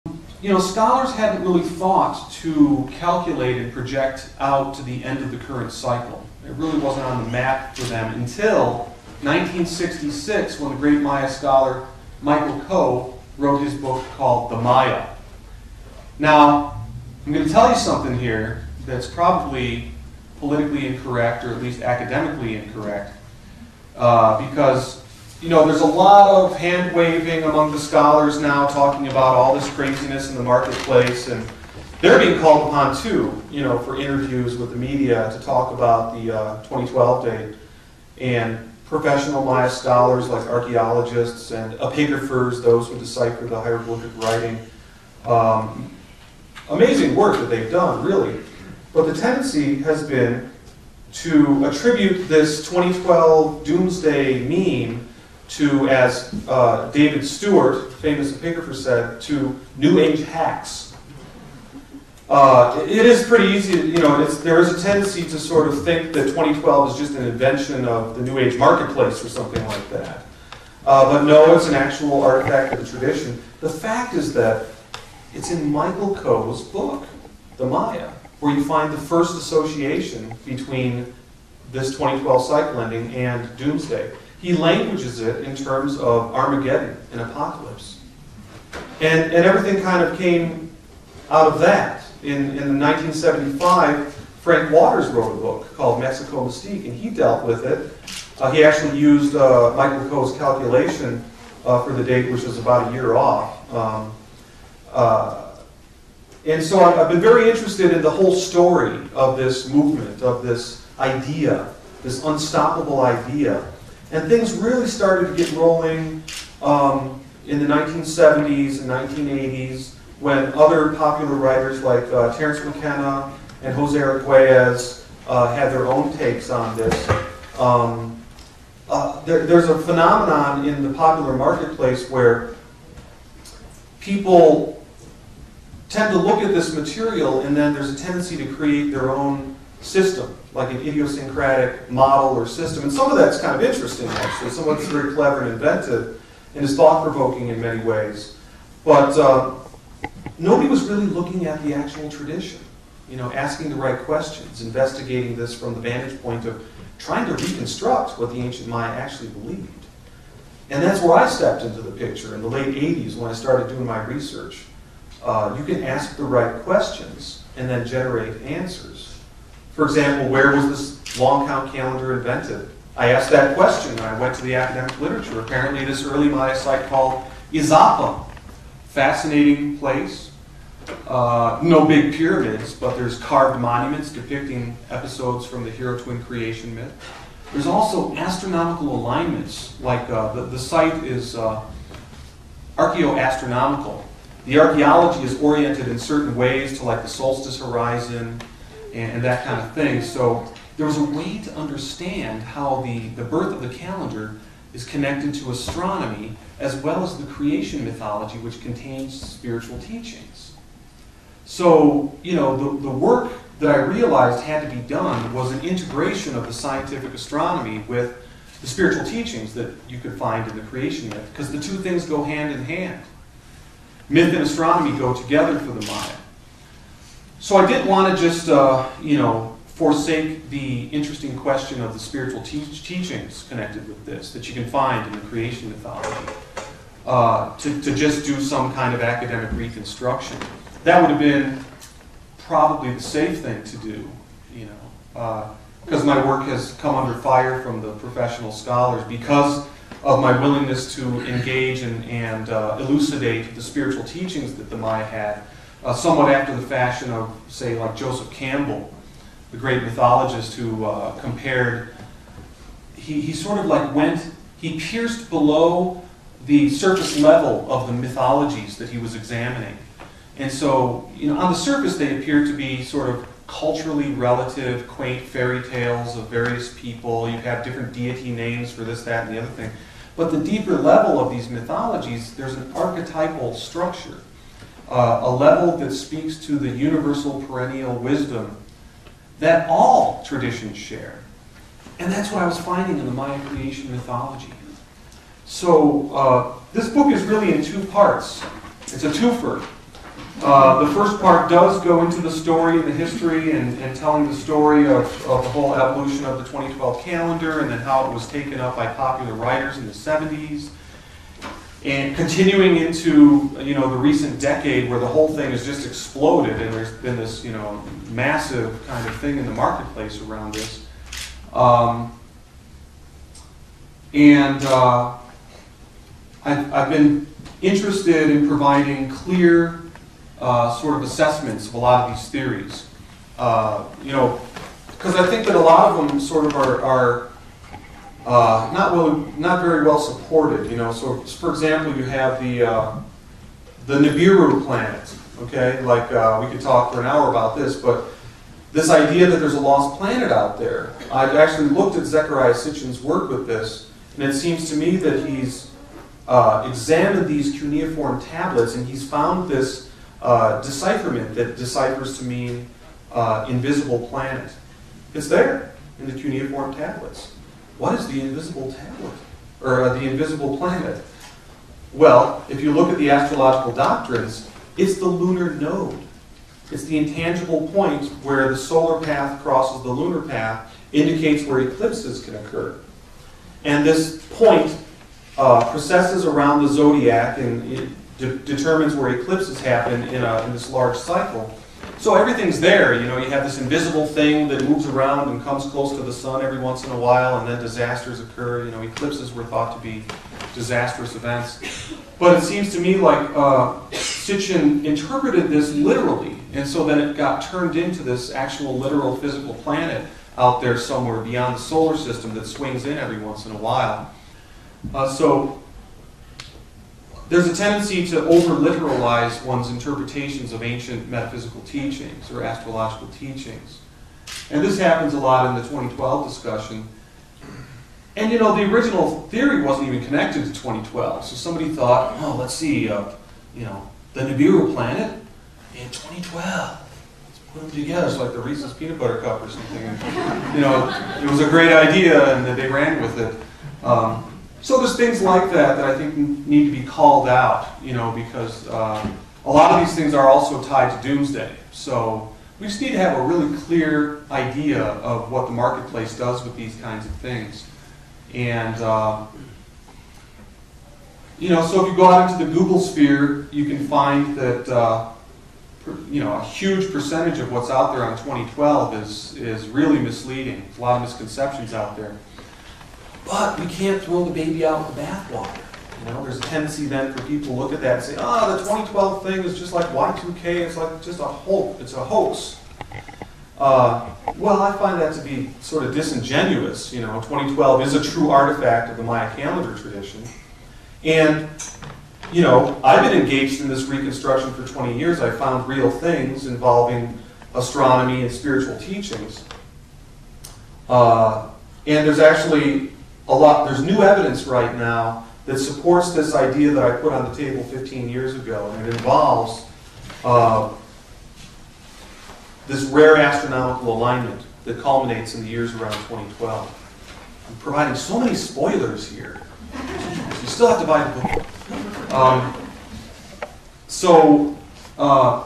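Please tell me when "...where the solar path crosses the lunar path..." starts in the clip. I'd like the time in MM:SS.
06:18.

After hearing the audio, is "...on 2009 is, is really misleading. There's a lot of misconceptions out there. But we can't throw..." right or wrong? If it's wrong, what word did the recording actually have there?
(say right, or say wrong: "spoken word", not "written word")
wrong: "2012", not "2009".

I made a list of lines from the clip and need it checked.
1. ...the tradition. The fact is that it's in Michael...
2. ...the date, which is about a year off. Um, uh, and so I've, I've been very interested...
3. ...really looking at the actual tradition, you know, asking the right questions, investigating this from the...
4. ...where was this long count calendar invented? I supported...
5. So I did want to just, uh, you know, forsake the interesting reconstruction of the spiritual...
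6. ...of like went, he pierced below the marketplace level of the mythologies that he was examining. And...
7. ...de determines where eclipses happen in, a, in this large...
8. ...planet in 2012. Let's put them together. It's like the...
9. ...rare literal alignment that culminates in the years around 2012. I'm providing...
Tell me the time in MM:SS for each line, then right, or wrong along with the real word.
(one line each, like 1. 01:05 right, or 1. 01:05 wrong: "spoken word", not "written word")
1. 01:12 right
2. 01:41 right
3. 02:30 right
4. 02:50 wrong: "asked", not "supported"
5. 03:47 wrong: "question", not "reconstruction"
6. 04:23 wrong: "surface", not "marketplace"
7. 06:28 right
8. 07:14 right
9. 08:32 wrong: "astronomical", not "literal".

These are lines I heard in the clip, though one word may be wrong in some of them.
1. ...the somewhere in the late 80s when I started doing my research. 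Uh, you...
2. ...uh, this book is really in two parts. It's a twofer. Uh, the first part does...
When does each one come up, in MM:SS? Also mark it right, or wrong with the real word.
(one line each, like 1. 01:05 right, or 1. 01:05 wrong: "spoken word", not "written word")
1. 02:41 wrong: "picture", not "somewhere"
2. 04:56 right.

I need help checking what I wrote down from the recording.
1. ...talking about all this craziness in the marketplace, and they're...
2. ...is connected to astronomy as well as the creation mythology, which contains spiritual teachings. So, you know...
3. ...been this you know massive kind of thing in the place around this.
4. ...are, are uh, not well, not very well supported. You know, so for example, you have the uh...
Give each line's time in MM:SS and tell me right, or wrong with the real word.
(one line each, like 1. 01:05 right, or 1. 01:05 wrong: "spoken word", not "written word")
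1. 00:28 right
2. 03:24 right
3. 05:16 wrong: "marketplace", not "place"
4. 05:36 right.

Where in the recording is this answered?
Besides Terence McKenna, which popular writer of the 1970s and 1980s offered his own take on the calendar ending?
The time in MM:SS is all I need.
02:03.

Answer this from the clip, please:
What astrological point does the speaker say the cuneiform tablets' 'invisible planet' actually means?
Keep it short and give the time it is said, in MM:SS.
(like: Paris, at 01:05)
The lunar node, at 06:15.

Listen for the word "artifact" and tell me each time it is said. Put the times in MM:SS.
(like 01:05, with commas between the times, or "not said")
01:12, 08:08.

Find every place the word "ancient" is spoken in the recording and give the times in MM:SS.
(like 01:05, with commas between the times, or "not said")
02:38, 07:00.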